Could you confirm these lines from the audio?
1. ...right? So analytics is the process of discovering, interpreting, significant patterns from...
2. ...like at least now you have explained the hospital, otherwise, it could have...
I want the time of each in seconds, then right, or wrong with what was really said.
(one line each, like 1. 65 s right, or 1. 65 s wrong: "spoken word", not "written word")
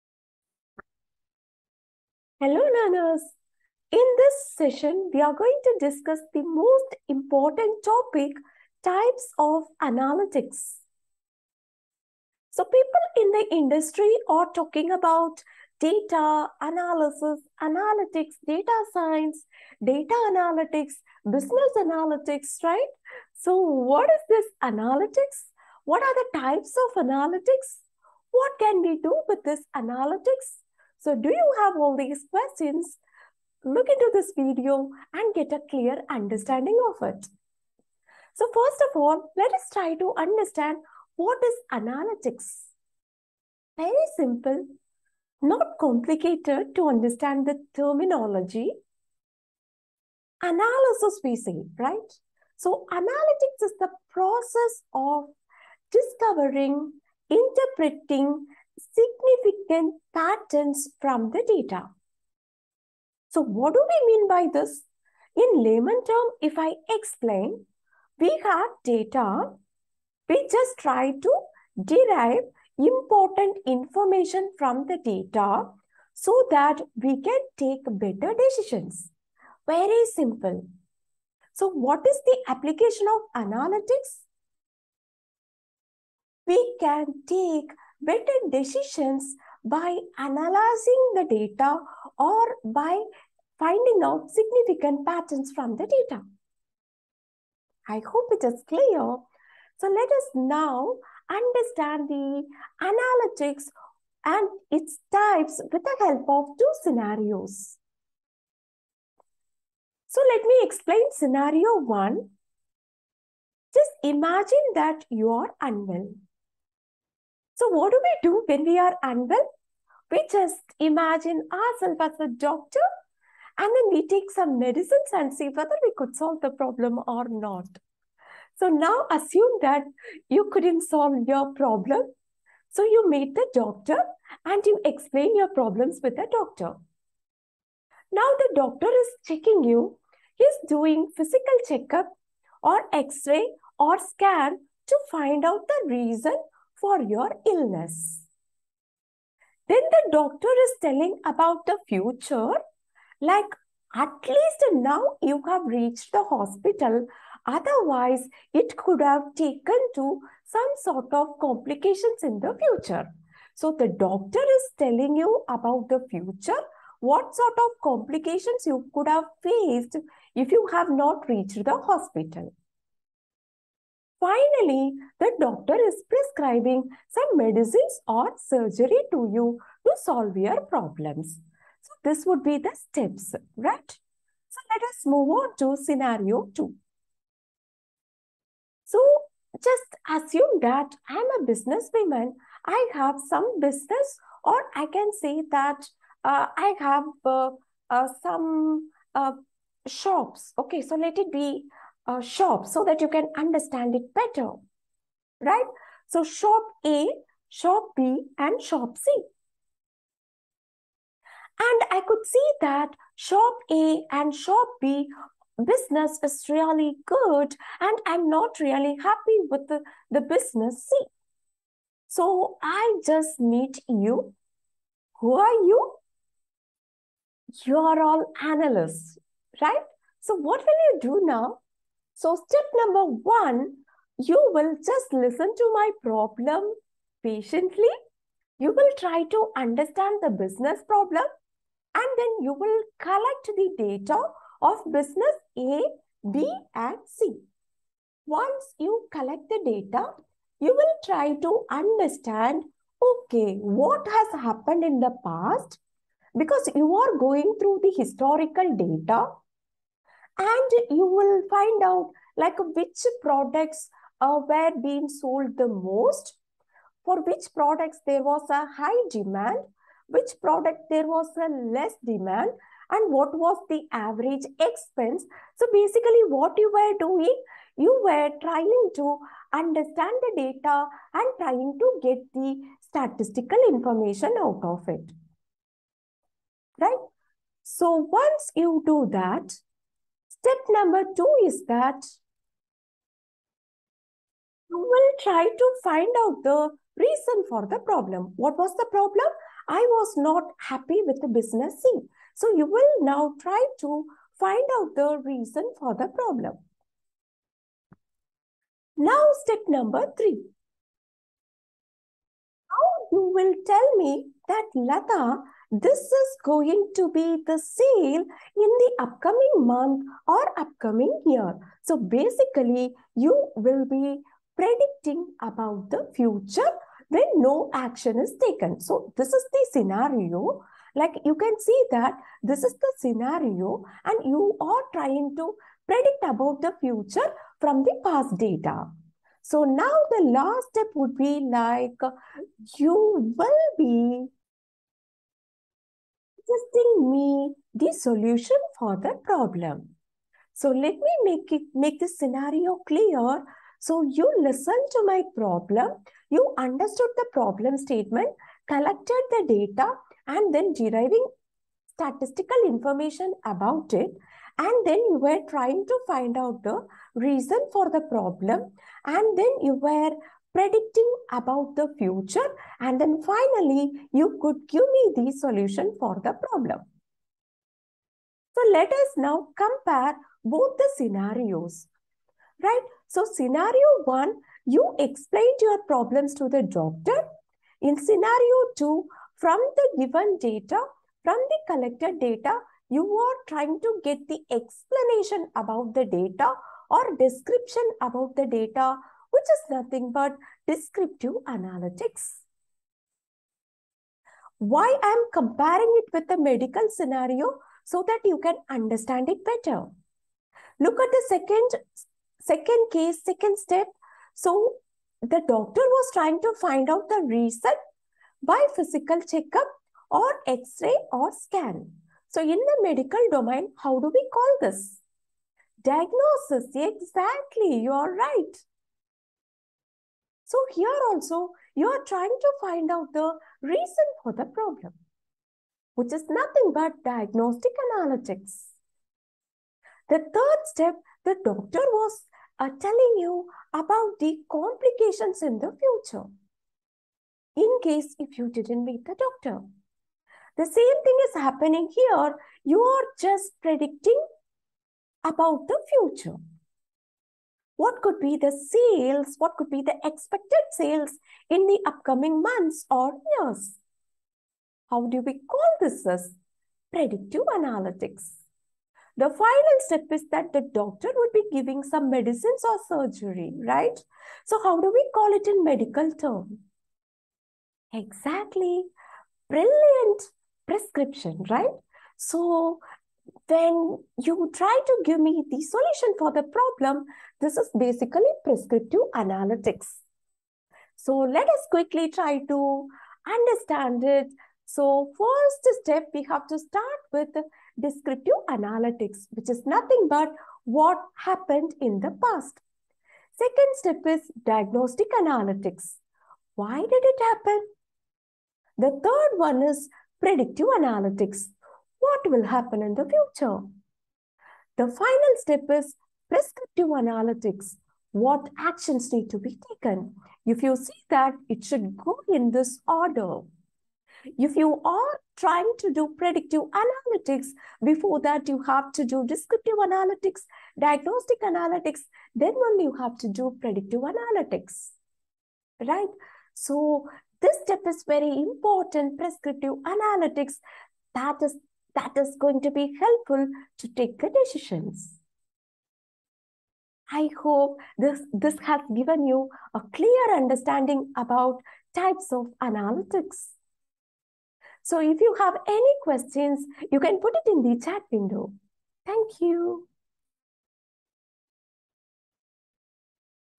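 1. 51 s right
2. 153 s wrong: "reached", not "explained".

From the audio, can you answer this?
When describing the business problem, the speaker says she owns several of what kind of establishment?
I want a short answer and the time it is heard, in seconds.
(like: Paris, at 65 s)
Shops, at 199 s.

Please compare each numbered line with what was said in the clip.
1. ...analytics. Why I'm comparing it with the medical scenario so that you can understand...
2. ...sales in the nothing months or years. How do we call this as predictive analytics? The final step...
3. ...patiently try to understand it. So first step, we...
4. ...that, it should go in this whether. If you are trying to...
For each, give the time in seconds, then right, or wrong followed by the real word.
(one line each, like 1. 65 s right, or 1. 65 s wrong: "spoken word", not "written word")
1. 401 s right
2. 460 s wrong: "upcoming", not "nothing"
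3. 491 s wrong: "quickly", not "patiently"
4. 521 s wrong: "order", not "whether".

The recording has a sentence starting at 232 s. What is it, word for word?
So step number one, you will just listen to my problem patiently.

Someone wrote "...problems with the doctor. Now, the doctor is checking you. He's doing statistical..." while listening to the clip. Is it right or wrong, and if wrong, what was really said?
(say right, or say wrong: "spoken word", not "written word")
wrong: "physical", not "statistical".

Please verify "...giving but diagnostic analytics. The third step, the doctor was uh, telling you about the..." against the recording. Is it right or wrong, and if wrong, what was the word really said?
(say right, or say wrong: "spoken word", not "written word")
wrong: "nothing", not "giving".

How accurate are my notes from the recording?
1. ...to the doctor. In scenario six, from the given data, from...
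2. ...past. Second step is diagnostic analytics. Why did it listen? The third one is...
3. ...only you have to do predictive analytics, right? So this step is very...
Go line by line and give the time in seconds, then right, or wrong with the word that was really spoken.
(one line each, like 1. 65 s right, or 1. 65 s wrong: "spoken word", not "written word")
1. 386 s wrong: "two", not "six"
2. 502 s wrong: "happen", not "listen"
3. 532 s right.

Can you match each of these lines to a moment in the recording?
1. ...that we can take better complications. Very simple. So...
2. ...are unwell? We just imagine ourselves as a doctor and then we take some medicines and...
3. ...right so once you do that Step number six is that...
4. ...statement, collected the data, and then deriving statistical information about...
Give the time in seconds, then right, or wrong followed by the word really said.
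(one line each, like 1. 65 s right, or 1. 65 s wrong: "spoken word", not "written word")
1. 76 s wrong: "decisions", not "complications"
2. 118 s right
3. 286 s wrong: "two", not "six"
4. 357 s right.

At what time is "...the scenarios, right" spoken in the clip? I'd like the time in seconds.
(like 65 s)
380 s.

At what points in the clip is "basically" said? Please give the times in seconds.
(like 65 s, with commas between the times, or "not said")
275 s, 321 s, 487 s.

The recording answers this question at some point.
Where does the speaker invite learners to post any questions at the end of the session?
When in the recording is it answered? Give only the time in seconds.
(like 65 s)
557 s.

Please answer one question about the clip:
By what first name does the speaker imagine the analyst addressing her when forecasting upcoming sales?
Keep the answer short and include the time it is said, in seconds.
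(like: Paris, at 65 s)
Lata, at 314 s.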